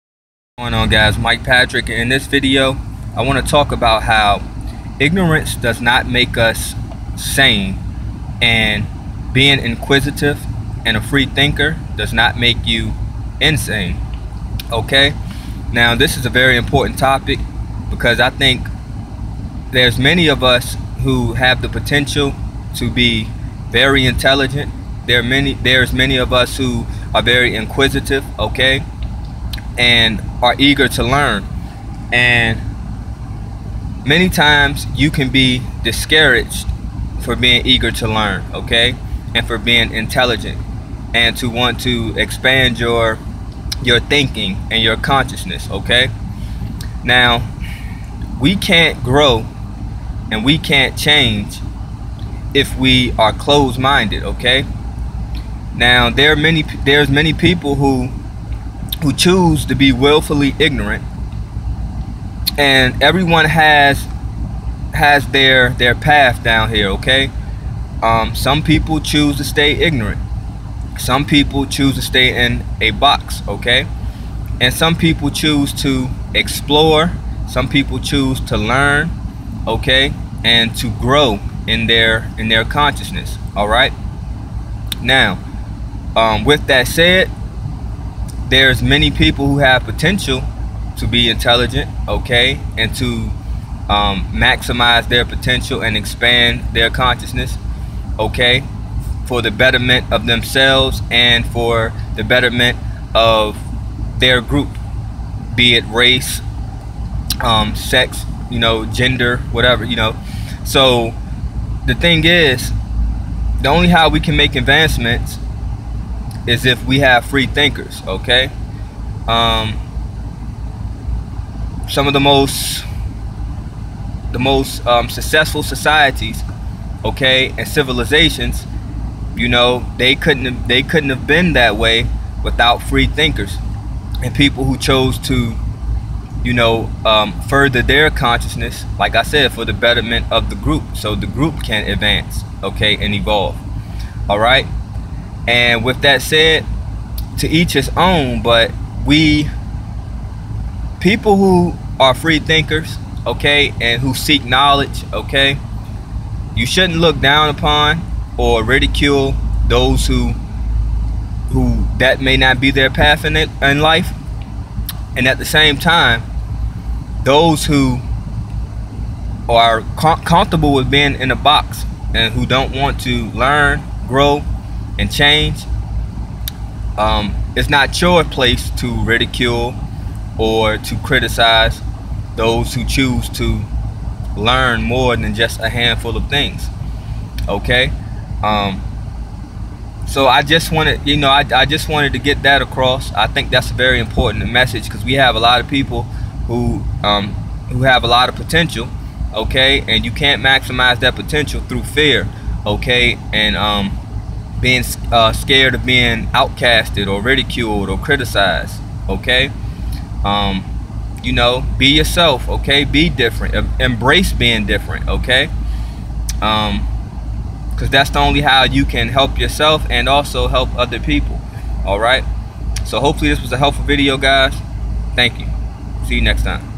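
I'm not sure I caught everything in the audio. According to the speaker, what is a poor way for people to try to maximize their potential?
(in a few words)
fear.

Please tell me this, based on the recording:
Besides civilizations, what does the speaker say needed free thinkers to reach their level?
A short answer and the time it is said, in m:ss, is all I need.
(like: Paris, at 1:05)
successful societies, at 2:05.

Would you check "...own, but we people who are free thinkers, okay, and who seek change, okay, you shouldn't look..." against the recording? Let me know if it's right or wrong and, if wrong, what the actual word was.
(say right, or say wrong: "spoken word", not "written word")
wrong: "knowledge", not "change".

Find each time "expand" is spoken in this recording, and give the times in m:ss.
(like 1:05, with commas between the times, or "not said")
0:42, 1:35.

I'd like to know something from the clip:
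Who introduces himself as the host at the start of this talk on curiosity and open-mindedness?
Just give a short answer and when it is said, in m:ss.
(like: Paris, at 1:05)
Mike Patrick, at 0:01.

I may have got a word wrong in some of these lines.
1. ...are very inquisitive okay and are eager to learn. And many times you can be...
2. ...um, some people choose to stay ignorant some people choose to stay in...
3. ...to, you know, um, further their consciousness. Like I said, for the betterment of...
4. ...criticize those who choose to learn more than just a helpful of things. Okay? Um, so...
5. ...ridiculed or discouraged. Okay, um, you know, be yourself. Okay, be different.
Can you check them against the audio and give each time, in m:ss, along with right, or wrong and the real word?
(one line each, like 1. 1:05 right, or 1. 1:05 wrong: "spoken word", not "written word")
1. 0:27 right
2. 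1:08 right
3. 2:15 right
4. 3:01 wrong: "handful", not "helpful"
5. 3:27 wrong: "criticized", not "discouraged".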